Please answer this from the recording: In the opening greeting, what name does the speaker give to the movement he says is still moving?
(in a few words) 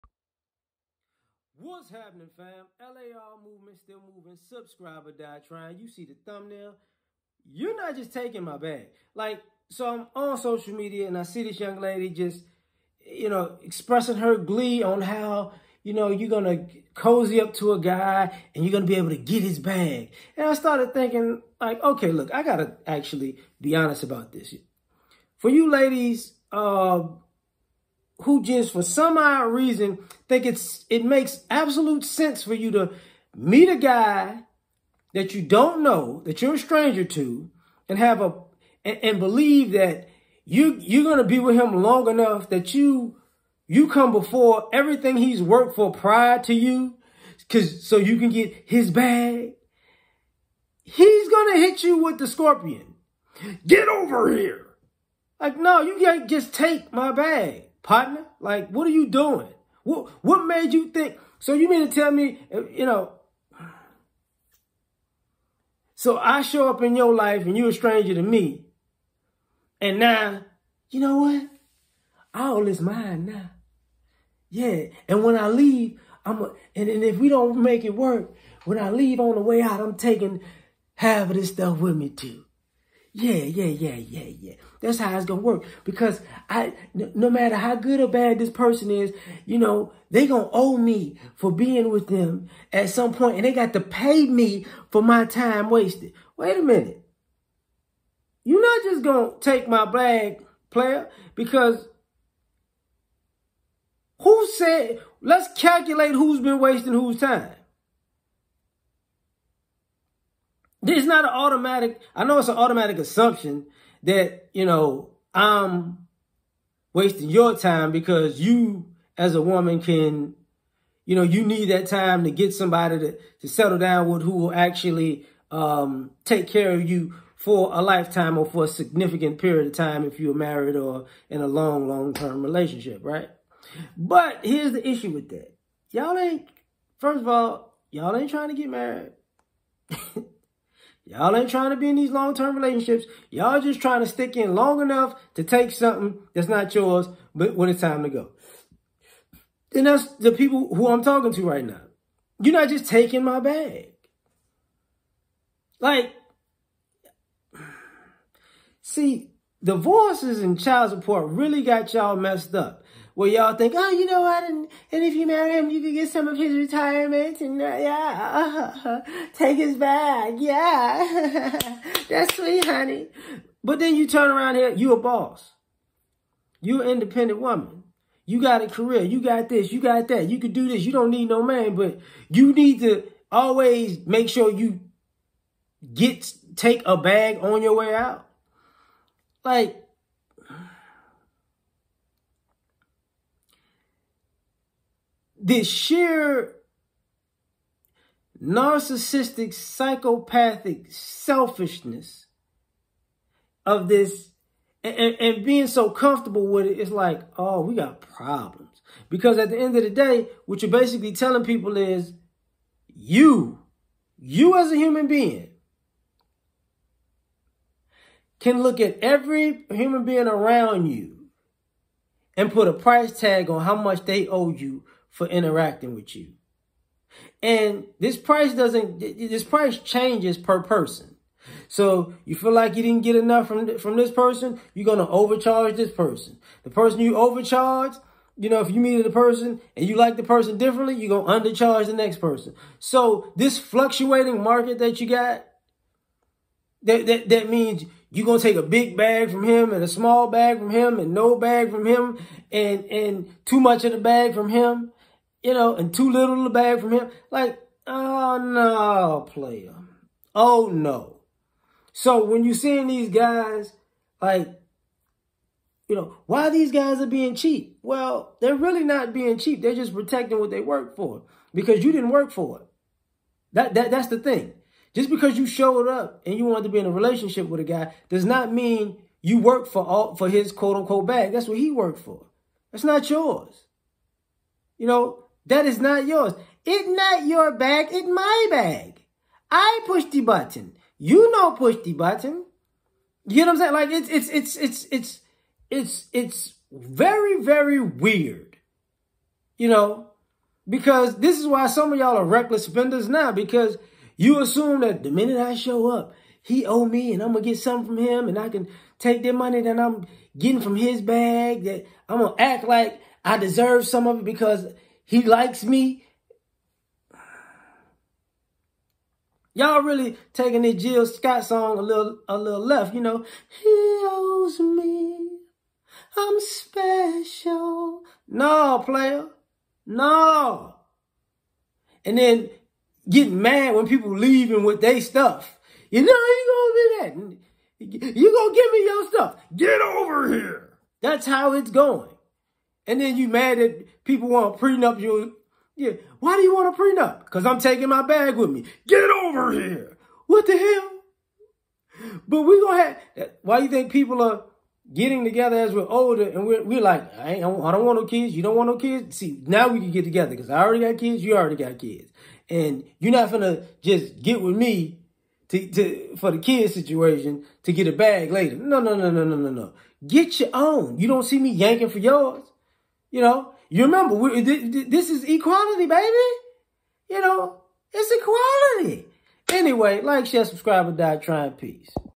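LAR movement.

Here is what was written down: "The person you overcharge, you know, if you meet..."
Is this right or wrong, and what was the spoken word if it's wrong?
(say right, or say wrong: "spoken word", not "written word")
right.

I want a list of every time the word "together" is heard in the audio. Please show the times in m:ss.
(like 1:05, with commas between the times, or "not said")
5:55, 6:00.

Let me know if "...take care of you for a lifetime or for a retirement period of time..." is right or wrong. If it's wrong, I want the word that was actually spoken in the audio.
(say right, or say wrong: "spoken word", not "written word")
wrong: "significant", not "retirement".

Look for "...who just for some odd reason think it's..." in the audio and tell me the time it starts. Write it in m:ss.
0:28.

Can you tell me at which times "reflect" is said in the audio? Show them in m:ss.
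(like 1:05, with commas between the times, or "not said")
not said.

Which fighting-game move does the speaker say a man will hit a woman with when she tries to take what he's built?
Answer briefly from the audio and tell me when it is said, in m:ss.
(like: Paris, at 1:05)
The scorpion, at 0:52.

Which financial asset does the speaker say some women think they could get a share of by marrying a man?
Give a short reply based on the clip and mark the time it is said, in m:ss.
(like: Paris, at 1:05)
Retirement, at 2:46.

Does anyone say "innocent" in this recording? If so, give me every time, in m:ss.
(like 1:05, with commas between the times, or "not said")
not said.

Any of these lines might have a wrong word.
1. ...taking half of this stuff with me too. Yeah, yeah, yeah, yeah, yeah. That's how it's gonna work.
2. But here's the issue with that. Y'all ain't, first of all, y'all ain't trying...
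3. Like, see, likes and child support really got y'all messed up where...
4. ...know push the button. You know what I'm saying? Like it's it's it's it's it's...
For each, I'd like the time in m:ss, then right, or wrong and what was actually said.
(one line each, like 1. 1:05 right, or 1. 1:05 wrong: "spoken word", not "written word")
1. 1:19 right
2. 2:13 right
3. 2:35 wrong: "divorces", not "likes"
4. 4:51 right.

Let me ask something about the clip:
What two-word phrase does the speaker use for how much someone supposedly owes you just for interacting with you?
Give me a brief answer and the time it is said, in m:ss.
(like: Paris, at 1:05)
Price tag, at 3:42.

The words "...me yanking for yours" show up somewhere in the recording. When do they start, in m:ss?
6:11.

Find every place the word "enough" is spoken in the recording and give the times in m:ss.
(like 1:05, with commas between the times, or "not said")
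0:42, 2:24, 3:53.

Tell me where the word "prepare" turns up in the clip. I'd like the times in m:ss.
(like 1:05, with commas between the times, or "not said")
not said.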